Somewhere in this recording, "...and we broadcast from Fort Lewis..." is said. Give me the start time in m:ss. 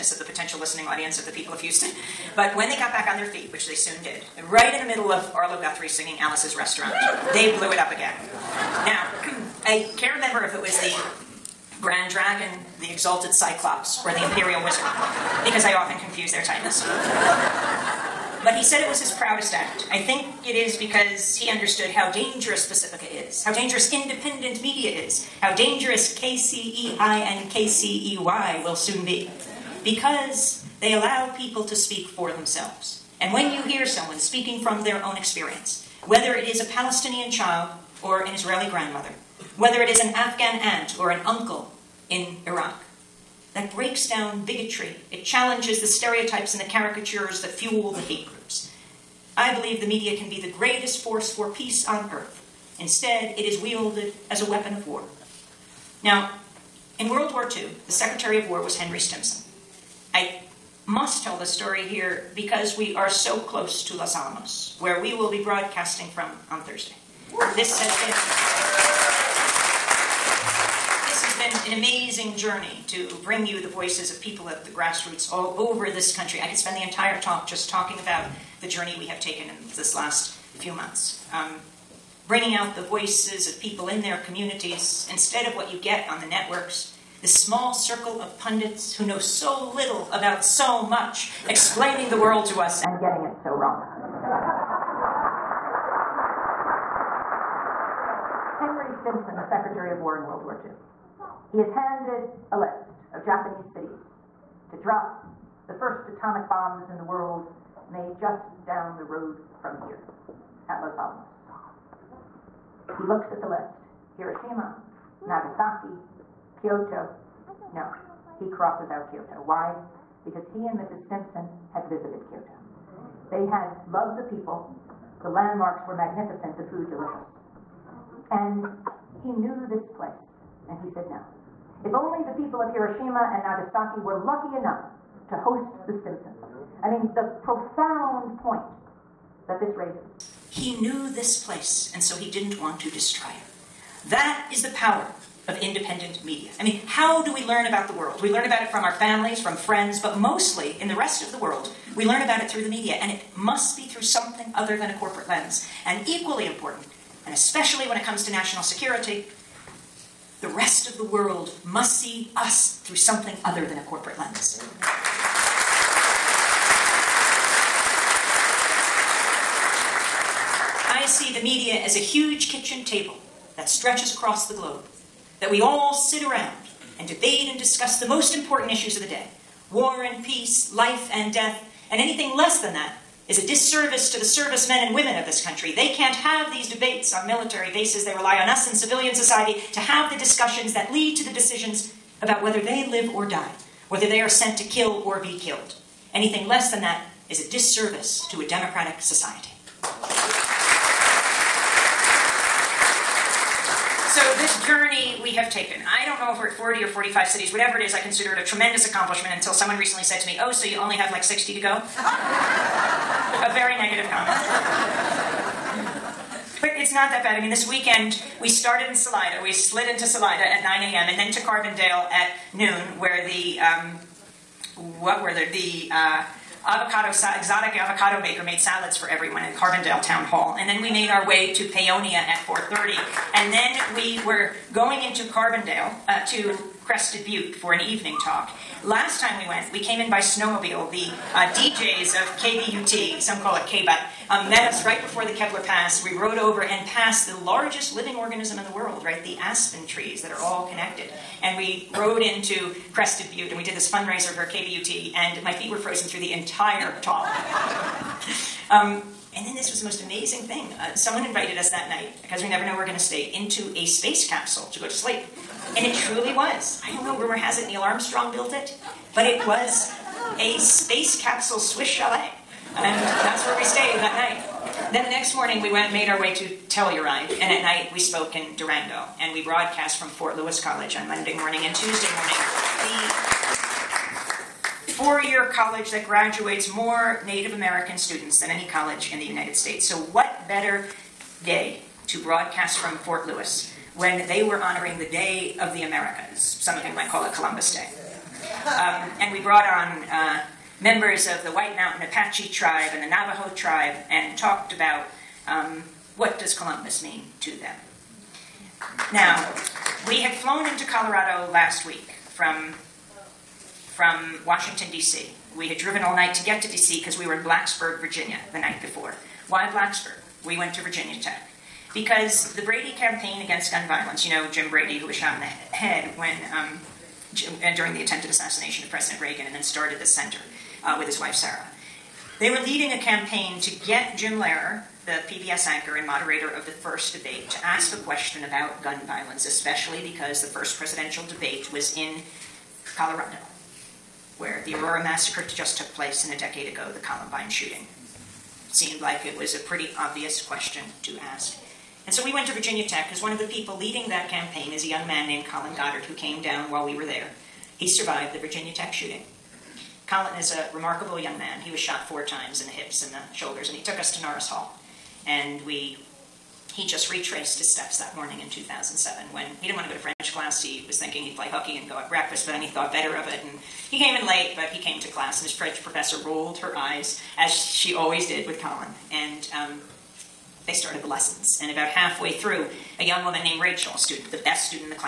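4:39.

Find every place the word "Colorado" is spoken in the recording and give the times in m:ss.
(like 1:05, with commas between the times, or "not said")
5:10, 5:42.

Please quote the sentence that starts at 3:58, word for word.
Last time we went, we came in by snowmobile.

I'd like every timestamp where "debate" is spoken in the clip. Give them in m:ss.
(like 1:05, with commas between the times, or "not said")
2:57, 3:06, 5:37, 5:41.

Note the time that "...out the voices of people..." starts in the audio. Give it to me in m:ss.
1:22.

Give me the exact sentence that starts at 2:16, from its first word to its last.
I mean, the profound point that this raises.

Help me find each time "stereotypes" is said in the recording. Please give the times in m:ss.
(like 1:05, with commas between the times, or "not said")
0:45.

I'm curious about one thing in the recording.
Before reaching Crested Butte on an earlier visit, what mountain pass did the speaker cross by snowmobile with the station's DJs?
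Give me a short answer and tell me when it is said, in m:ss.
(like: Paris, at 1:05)
Kebler Pass, at 4:05.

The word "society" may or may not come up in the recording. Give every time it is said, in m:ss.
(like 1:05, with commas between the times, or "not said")
3:09, 3:18.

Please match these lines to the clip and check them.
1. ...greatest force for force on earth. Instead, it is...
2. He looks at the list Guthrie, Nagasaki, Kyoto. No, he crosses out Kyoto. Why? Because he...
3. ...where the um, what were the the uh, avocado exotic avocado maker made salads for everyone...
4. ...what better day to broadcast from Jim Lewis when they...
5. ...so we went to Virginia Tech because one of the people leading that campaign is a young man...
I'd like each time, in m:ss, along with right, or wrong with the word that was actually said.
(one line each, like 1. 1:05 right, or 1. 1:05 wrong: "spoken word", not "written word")
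1. 0:50 wrong: "peace", not "force"
2. 1:52 wrong: "Hiroshima", not "Guthrie"
3. 3:42 right
4. 4:49 wrong: "Fort", not "Jim"
5. 5:52 right.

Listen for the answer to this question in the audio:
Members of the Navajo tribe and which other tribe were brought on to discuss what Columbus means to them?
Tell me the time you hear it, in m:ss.
5:01.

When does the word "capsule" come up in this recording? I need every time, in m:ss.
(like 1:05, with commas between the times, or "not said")
4:24, 4:31.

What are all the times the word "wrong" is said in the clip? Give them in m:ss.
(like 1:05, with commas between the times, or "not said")
1:33.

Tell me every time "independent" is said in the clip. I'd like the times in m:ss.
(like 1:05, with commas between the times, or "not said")
0:23, 2:25.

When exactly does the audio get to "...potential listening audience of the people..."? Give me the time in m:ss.
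0:00.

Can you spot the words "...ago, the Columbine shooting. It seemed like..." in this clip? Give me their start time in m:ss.
5:46.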